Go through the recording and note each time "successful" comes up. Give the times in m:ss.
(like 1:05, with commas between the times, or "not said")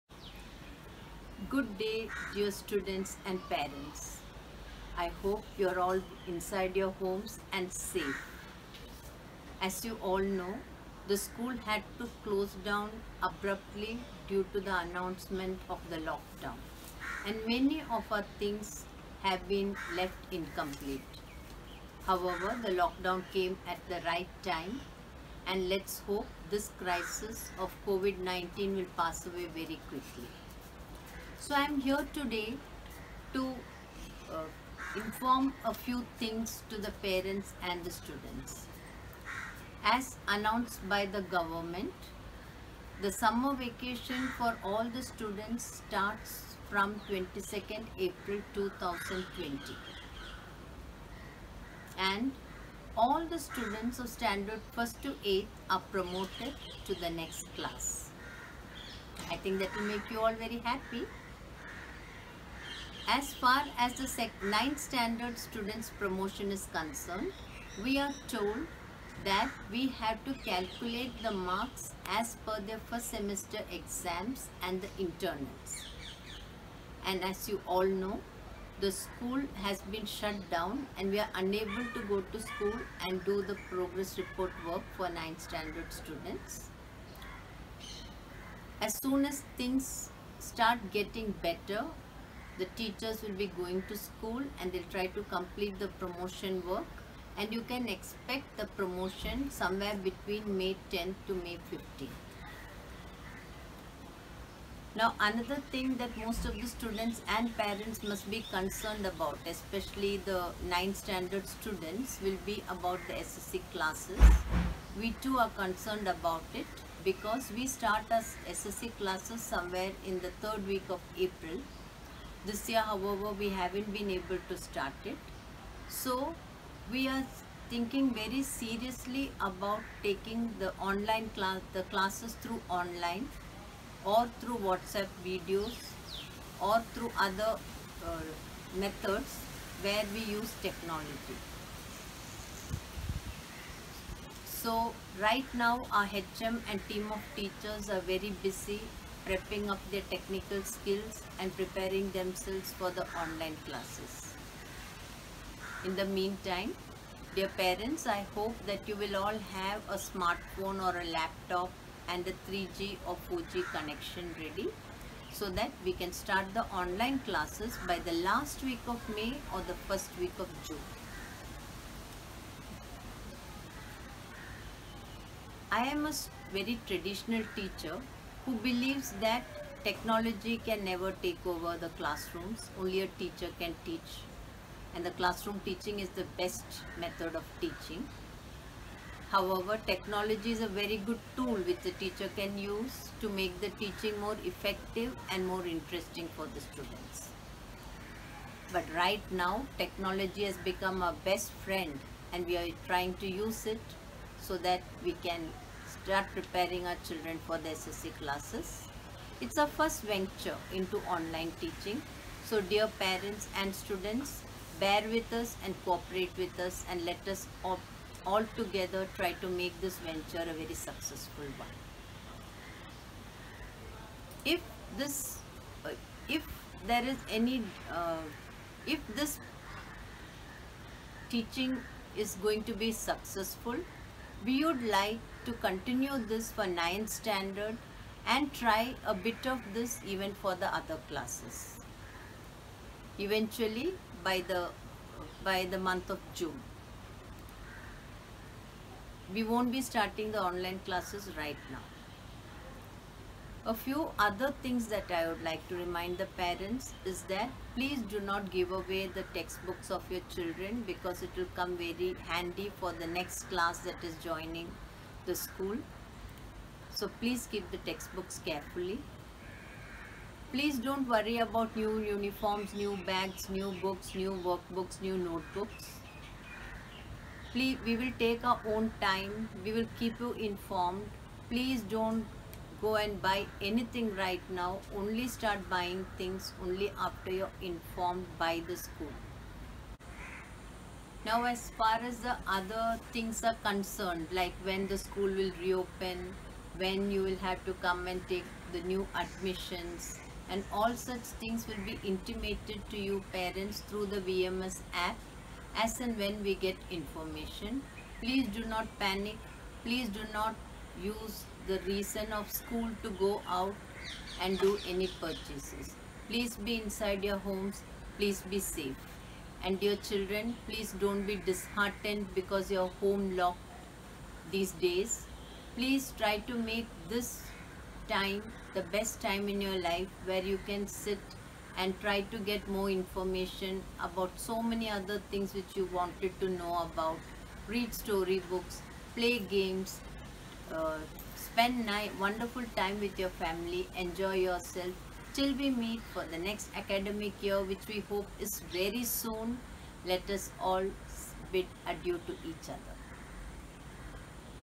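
3:40, 3:52.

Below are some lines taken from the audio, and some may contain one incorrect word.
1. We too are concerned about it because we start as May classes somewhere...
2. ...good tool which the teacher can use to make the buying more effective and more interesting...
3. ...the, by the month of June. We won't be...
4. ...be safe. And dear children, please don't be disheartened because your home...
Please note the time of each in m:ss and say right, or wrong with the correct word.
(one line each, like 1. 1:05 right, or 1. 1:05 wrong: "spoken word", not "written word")
1. 1:54 wrong: "SSC", not "May"
2. 3:10 wrong: "teaching", not "buying"
3. 4:04 right
4. 5:18 right.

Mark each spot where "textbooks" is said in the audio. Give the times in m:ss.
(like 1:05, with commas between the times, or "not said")
4:19, 4:27.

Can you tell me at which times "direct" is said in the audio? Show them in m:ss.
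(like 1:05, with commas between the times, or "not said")
not said.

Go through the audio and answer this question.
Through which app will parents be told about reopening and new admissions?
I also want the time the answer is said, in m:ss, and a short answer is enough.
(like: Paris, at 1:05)
VMS app, at 5:04.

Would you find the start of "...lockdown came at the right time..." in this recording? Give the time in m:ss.
0:22.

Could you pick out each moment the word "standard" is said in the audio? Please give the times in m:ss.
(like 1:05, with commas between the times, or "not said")
0:54, 1:04, 1:25, 1:50, 3:57.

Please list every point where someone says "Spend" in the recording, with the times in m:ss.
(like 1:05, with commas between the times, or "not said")
5:41.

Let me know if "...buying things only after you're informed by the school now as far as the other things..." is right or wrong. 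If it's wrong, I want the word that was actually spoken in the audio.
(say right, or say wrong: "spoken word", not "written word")
right.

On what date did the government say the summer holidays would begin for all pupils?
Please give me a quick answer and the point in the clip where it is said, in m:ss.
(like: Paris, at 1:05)
22nd April 2020, at 0:47.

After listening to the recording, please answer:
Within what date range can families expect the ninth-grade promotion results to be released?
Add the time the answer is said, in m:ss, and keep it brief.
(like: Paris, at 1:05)
May 10th to May 15th, at 1:40.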